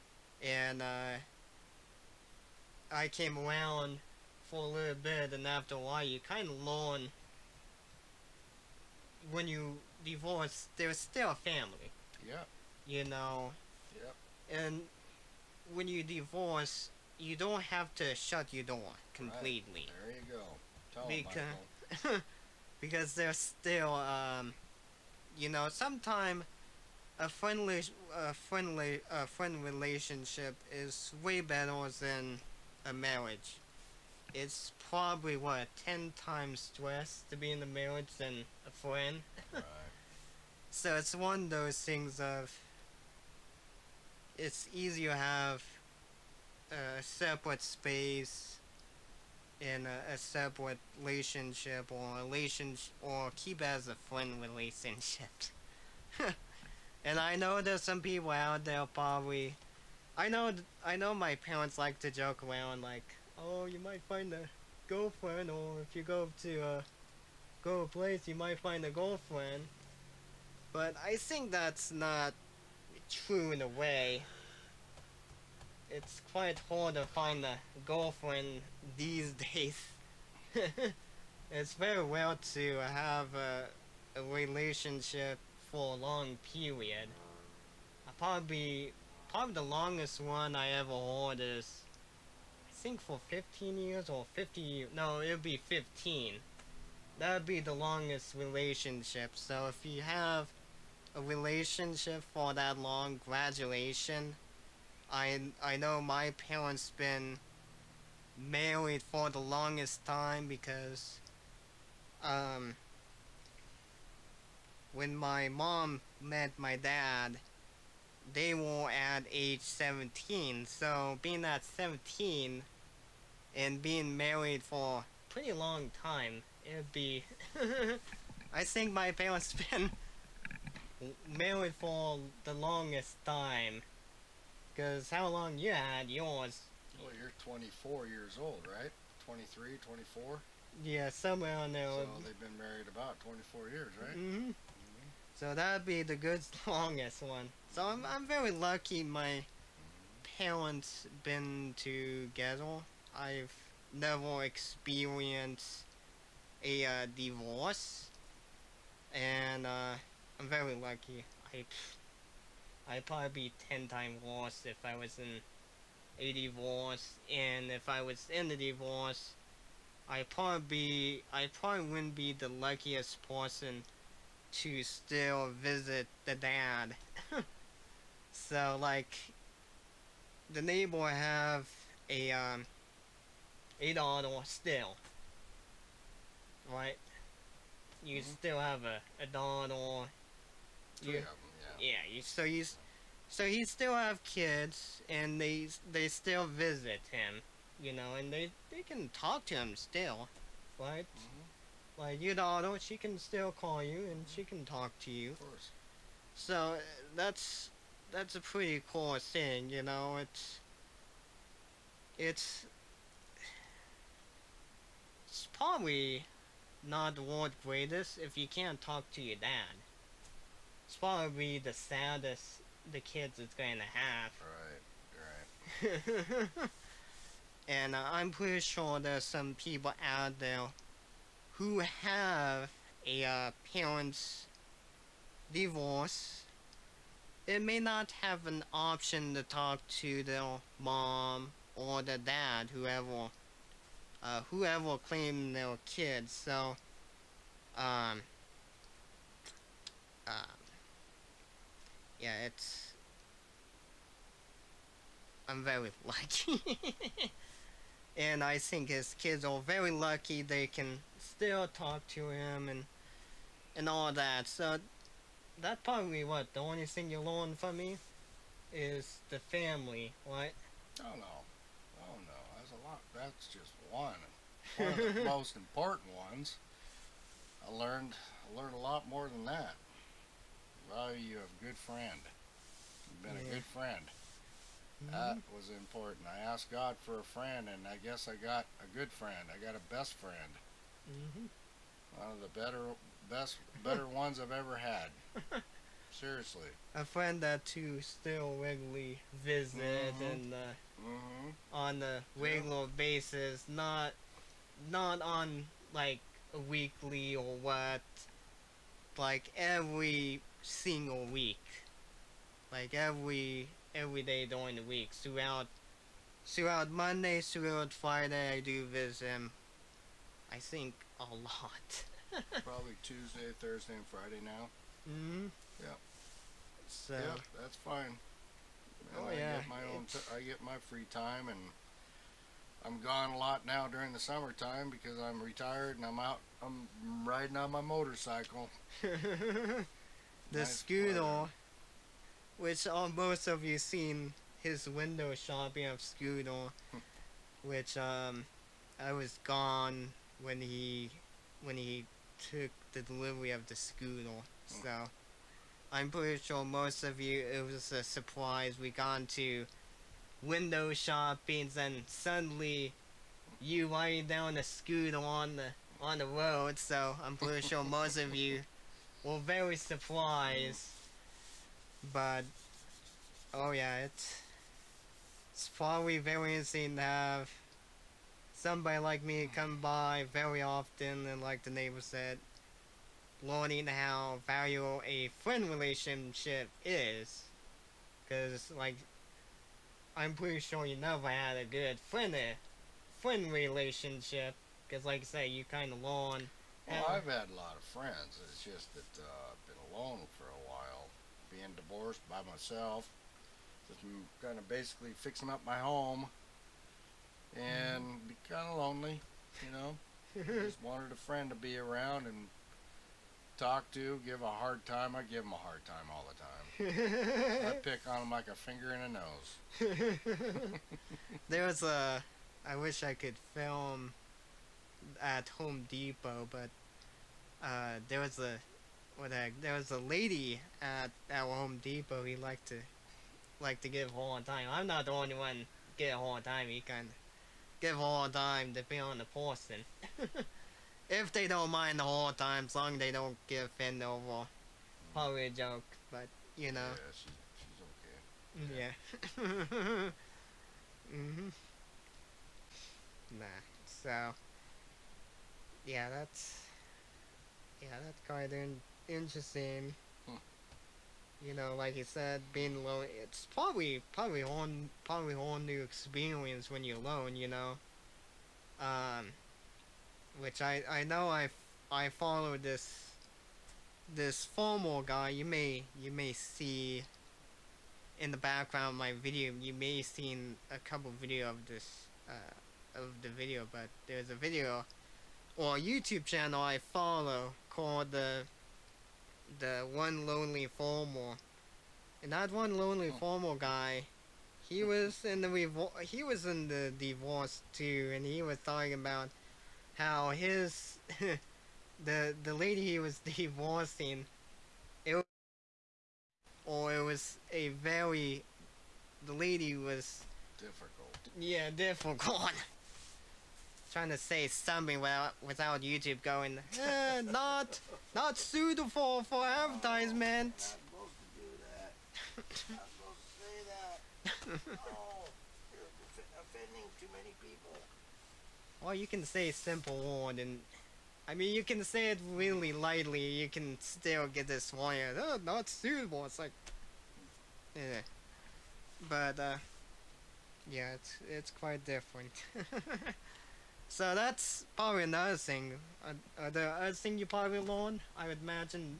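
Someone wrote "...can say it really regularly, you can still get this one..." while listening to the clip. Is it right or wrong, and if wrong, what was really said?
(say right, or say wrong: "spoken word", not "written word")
wrong: "lightly", not "regularly".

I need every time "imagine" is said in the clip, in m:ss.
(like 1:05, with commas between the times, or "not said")
9:08.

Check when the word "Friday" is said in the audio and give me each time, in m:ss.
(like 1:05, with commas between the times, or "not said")
5:17, 5:24.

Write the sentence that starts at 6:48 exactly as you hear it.
be kind of lonely, you know.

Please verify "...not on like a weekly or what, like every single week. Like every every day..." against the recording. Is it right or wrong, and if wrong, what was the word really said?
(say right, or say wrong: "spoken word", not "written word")
right.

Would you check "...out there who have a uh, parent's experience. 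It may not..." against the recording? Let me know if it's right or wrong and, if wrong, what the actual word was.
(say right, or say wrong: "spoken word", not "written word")
wrong: "divorce", not "experience".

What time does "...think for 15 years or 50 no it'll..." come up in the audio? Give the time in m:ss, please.
1:32.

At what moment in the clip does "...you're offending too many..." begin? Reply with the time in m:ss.
8:45.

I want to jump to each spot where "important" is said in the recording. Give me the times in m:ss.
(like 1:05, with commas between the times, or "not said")
4:35, 4:45.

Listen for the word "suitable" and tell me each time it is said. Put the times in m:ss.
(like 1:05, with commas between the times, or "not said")
8:38, 8:55.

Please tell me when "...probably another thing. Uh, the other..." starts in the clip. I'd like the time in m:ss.
9:04.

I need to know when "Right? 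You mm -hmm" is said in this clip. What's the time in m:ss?
3:06.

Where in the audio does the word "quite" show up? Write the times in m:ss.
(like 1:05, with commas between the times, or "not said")
1:16, 7:38, 9:01.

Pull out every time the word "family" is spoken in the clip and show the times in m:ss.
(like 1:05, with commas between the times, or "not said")
0:11, 4:29.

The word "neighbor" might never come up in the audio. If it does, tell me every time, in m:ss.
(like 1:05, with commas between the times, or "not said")
3:00, 6:21.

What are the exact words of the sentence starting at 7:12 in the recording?
He liked to like to give all the time.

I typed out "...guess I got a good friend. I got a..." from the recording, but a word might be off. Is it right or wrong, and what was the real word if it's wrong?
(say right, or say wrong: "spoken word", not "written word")
right.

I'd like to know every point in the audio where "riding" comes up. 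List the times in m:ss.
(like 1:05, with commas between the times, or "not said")
5:37, 6:03.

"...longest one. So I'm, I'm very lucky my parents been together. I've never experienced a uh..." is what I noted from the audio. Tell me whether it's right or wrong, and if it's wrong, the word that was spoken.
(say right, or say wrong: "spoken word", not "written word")
right.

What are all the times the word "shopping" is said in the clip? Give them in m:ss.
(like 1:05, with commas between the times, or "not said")
5:45, 6:00.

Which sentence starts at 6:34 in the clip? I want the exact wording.
Because, like I say, you kind of learn well, I've had a lot of friends.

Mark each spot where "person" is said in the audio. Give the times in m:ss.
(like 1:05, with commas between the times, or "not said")
2:53, 7:19.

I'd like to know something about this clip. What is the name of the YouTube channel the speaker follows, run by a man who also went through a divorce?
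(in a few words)
One Lonely Formal.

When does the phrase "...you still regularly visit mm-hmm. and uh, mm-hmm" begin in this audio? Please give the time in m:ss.
4:57.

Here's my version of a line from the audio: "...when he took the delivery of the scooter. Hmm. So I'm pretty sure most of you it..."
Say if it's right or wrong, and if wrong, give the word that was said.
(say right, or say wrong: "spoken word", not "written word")
right.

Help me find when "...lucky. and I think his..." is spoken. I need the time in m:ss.
4:16.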